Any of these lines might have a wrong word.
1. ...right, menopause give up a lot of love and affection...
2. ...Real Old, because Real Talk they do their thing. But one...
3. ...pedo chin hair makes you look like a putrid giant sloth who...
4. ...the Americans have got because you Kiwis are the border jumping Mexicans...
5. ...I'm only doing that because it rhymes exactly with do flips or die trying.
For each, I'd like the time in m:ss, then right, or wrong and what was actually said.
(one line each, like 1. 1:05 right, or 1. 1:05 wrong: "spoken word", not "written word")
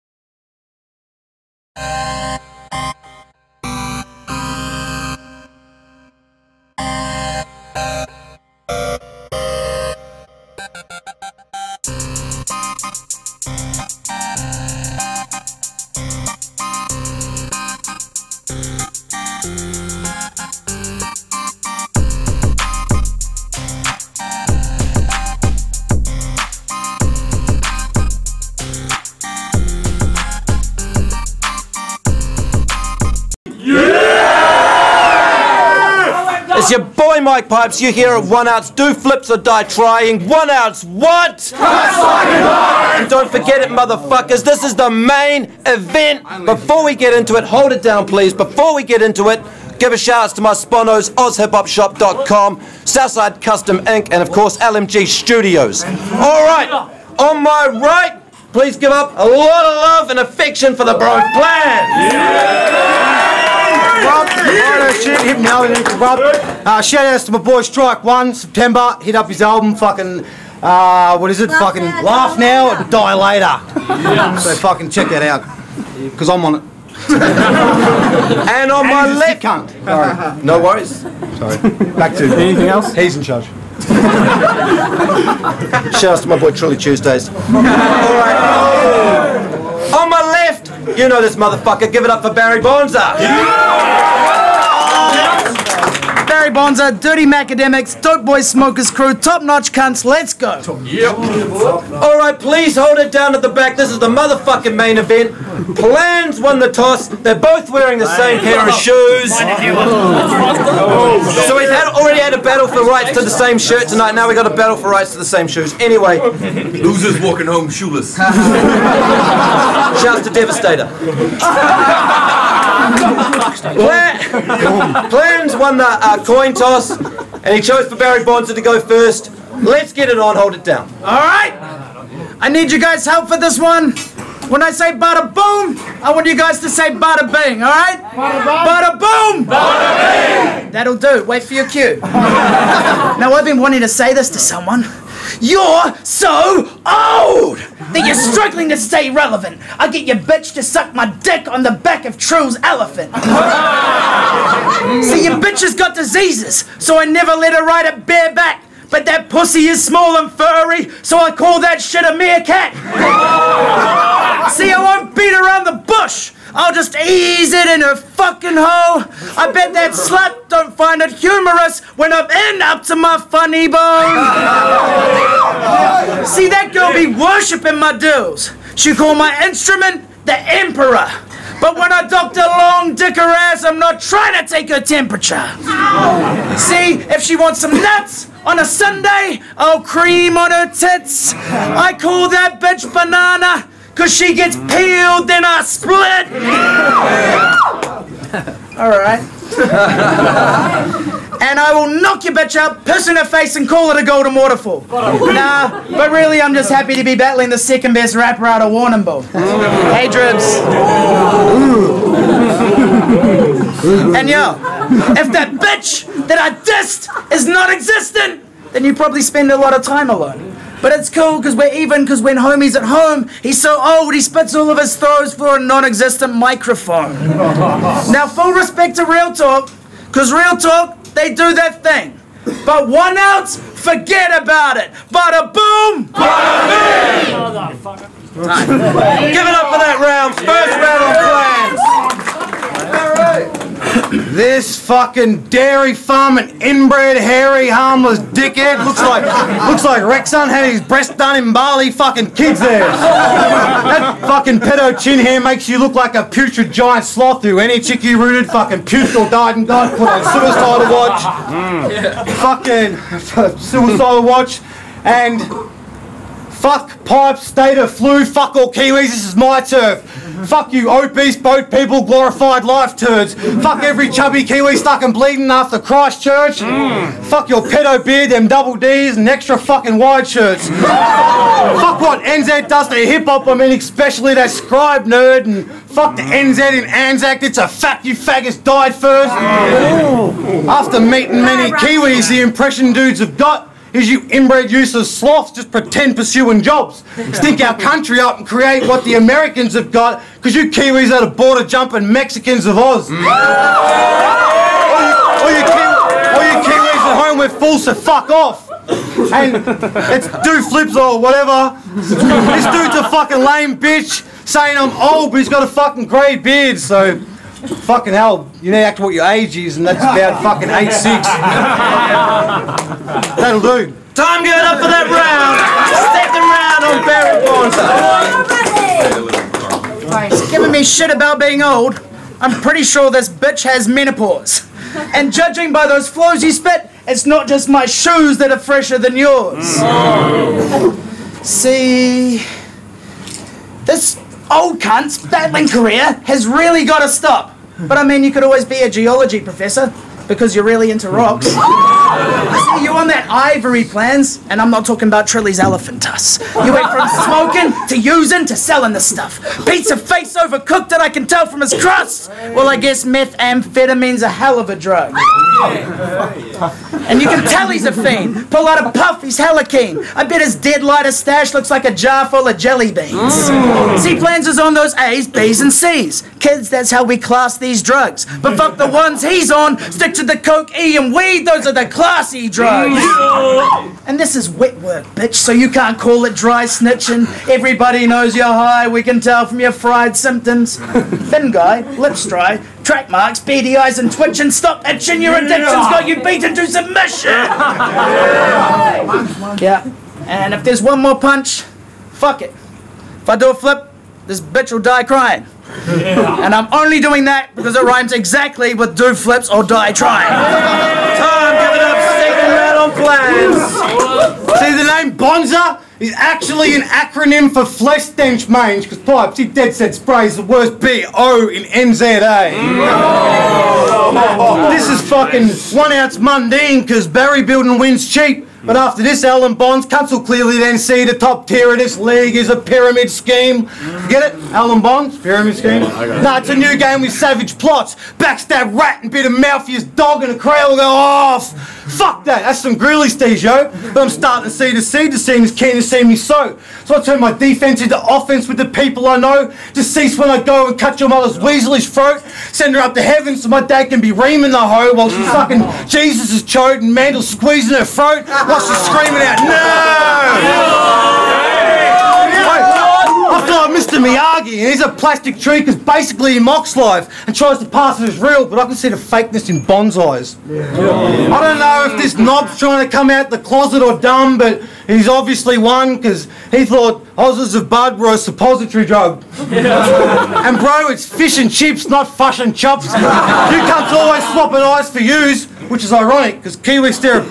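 1. 0:57 wrong: "please", not "menopause"
2. 3:49 wrong: "Talk", not "Old"
3. 4:14 right
4. 4:59 right
5. 6:46 right.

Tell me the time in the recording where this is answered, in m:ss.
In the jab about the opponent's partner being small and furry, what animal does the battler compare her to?
2:42.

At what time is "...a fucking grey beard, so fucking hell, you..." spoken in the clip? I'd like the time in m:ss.
5:15.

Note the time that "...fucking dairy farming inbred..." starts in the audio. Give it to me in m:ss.
4:04.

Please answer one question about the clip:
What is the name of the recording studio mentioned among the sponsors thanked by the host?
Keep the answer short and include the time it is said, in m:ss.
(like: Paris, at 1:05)
LMG Studios, at 0:54.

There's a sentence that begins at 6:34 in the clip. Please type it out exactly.
Stop itching, your addiction's got you beaten to submission.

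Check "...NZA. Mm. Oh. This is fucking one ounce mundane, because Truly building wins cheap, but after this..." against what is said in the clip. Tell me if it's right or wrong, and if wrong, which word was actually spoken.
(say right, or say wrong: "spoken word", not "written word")
wrong: "Barry", not "Truly".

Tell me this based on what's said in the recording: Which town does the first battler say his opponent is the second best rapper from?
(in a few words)
Warrnambool.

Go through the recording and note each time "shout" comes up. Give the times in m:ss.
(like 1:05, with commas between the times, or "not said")
0:49, 1:06, 1:25, 1:58.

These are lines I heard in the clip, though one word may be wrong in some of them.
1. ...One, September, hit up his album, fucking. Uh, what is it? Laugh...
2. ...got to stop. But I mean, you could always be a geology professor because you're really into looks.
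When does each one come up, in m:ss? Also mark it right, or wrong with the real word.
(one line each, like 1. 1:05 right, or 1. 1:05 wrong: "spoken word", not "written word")
1. 1:08 right
2. 5:46 wrong: "rocks", not "looks".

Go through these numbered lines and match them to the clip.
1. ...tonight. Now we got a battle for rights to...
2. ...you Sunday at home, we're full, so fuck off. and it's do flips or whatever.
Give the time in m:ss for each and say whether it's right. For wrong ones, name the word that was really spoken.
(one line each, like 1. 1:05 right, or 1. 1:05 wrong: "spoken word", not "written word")
1. 1:53 right
2. 5:06 wrong: "Kiwis", not "Sunday".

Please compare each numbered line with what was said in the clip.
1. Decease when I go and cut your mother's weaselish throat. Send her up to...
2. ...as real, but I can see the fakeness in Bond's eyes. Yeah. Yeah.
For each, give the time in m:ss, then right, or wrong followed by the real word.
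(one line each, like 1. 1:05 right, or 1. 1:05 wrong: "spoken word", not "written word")
1. 7:29 right
2. 7:48 right.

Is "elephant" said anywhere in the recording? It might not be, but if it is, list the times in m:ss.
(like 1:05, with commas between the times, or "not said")
2:32, 5:55.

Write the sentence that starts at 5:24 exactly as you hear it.
Time going up for that round.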